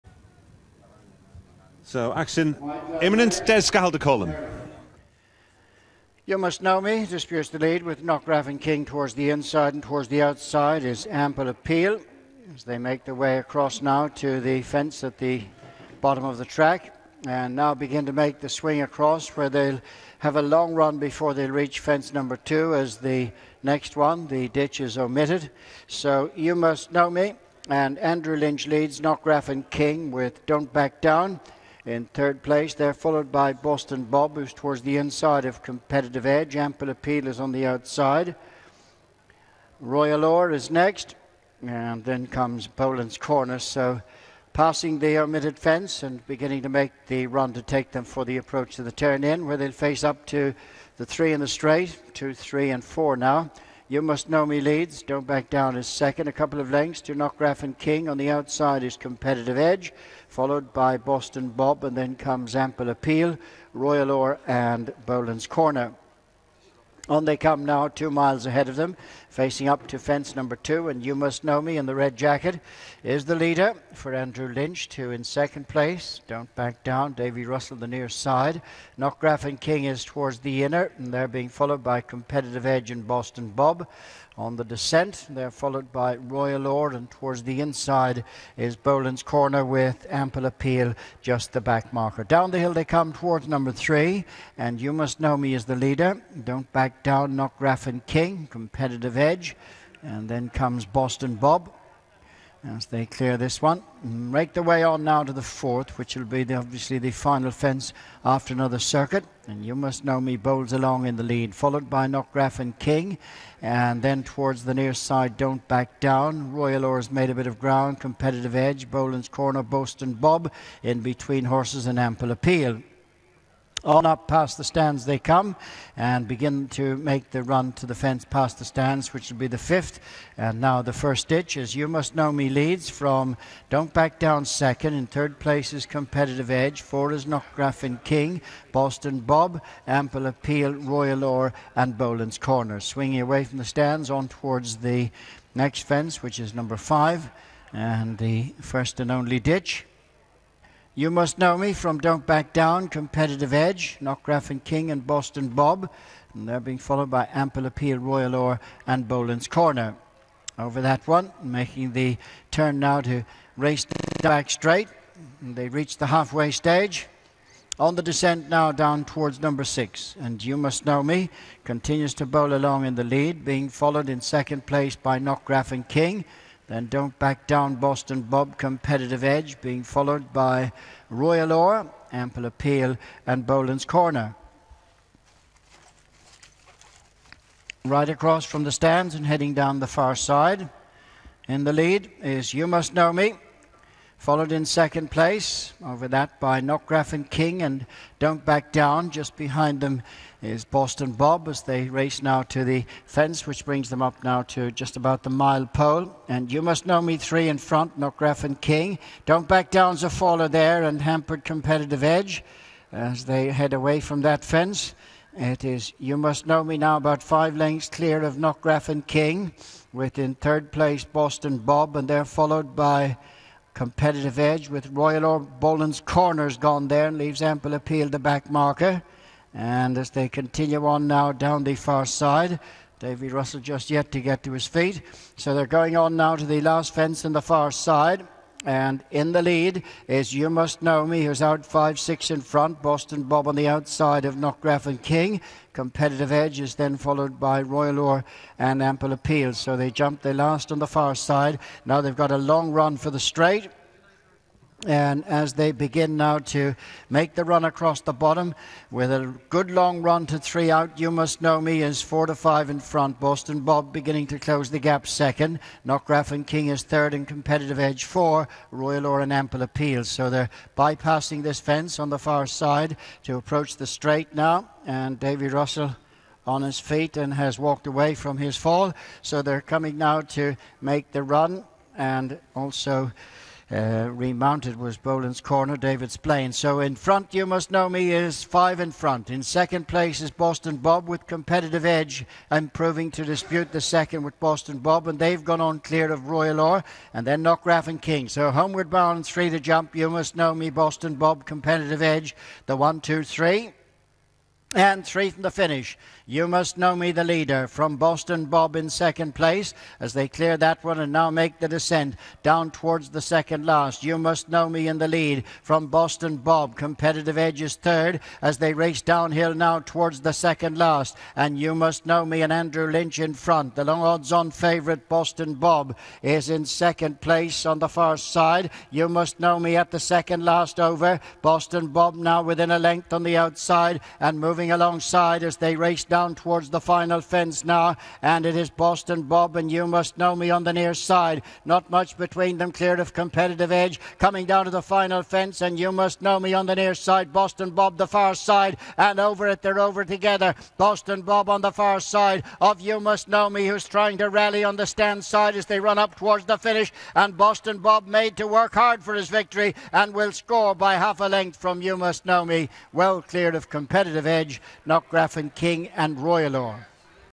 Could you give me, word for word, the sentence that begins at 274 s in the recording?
And Davy Russell on his feet and has walked away from his fall.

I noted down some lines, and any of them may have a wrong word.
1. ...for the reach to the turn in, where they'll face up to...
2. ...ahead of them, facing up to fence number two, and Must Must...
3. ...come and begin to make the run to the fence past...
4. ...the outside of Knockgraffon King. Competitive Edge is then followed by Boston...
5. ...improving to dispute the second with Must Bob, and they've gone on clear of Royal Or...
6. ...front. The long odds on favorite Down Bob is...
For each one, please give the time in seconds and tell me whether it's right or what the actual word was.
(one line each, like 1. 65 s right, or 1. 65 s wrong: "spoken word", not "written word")
1. 48 s wrong: "approach", not "reach"
2. 68 s wrong: "You", not "Must"
3. 125 s right
4. 243 s wrong: "Royal", not "Boston"
5. 292 s wrong: "Boston", not "Must"
6. 323 s wrong: "Boston", not "Down".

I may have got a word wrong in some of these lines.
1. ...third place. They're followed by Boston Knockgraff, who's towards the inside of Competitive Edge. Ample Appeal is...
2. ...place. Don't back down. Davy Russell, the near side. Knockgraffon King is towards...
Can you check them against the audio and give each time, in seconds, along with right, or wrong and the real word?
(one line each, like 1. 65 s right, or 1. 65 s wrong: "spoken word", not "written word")
1. 32 s wrong: "Bob", not "Knockgraff"
2. 75 s right.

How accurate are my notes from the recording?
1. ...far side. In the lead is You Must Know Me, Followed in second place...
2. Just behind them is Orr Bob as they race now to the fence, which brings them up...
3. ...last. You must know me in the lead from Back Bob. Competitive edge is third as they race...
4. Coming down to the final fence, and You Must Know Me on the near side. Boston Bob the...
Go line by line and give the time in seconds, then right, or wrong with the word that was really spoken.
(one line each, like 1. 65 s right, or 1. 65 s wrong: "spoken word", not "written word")
1. 189 s right
2. 199 s wrong: "Boston", not "Orr"
3. 313 s wrong: "Boston", not "Back"
4. 344 s right.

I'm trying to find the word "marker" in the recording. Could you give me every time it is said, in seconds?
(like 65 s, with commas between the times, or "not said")
91 s, 228 s.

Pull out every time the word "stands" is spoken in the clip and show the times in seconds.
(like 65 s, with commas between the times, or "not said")
124 s, 128 s, 143 s, 188 s, 354 s.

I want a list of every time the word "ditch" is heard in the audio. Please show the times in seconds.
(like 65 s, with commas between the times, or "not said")
24 s, 131 s, 149 s.